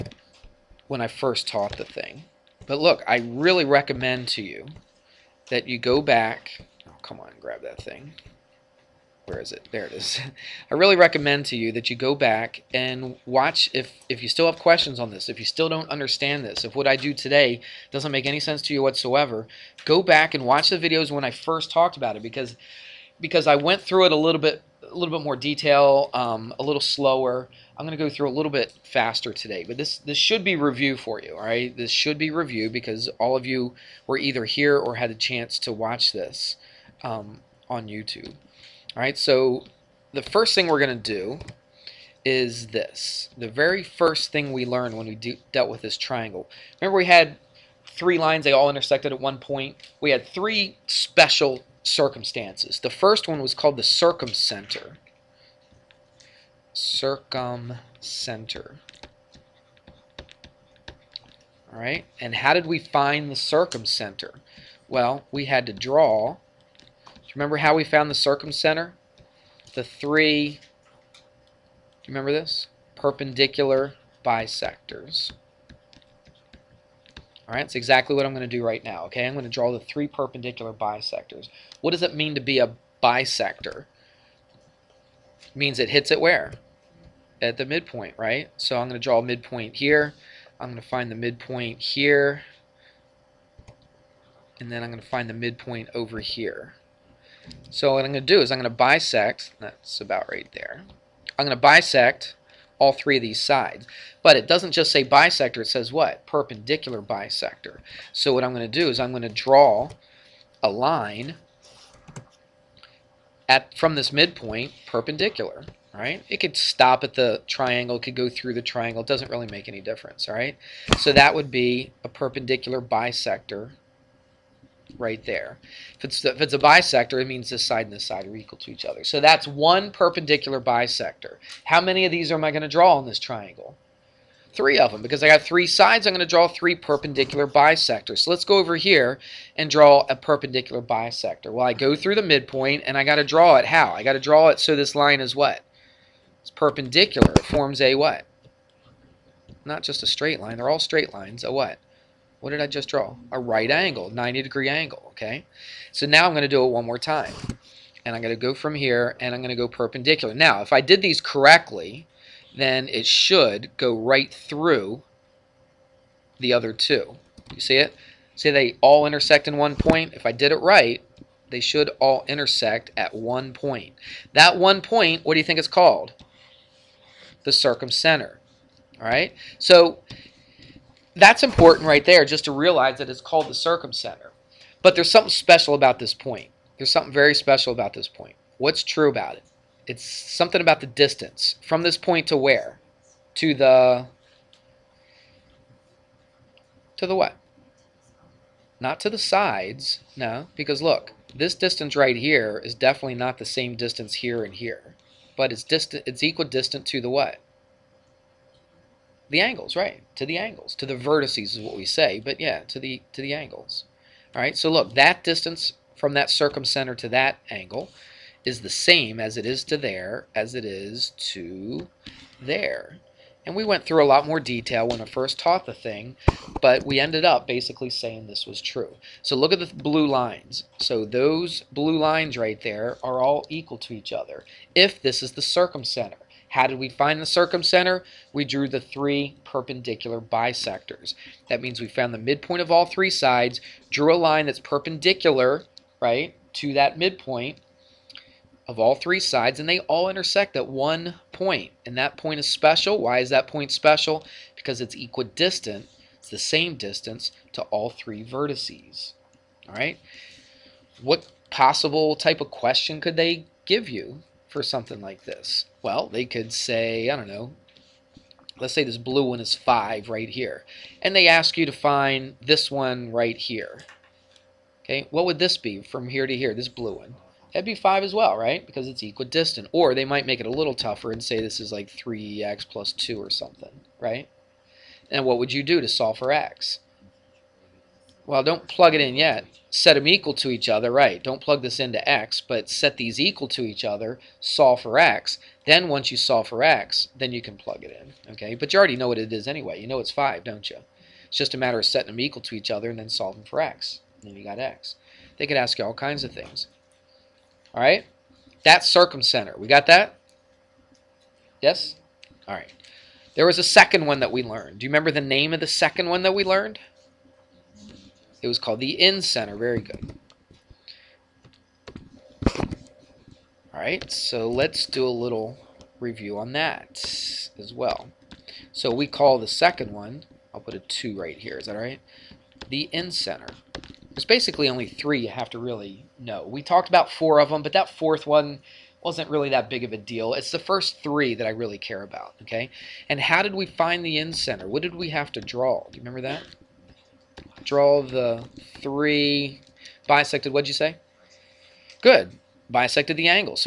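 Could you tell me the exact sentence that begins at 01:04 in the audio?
Well, we had to draw you remember how we found the circumcenter?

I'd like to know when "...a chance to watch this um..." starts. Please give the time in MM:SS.
00:35.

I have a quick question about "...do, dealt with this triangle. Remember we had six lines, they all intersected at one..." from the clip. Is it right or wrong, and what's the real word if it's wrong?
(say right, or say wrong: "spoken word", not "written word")
wrong: "three", not "six".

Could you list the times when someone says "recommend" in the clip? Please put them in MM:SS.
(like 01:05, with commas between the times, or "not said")
00:03, 00:10.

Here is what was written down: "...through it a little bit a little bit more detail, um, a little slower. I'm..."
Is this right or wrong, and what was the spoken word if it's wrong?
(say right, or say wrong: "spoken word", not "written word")
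right.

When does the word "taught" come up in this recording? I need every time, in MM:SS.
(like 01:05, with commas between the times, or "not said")
00:01, 03:45.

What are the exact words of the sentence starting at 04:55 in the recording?
Then once you solve for x, then you can plug it in, okay?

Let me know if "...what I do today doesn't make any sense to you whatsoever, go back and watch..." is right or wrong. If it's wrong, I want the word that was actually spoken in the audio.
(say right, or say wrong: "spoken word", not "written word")
right.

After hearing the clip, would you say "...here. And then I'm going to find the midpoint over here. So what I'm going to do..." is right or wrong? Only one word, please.
right.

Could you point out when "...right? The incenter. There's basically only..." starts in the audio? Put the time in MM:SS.
05:31.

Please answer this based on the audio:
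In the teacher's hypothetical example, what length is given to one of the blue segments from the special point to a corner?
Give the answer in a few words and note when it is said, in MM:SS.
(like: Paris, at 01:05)
5, at 04:28.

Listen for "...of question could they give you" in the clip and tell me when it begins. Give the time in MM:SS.
04:22.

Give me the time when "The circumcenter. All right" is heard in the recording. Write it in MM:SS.
02:57.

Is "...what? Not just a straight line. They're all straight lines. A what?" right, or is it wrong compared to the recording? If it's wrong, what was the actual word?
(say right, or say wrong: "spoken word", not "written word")
right.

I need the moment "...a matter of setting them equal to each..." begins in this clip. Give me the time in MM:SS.
05:01.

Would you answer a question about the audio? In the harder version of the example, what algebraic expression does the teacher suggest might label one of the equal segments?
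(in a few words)
3x + 2.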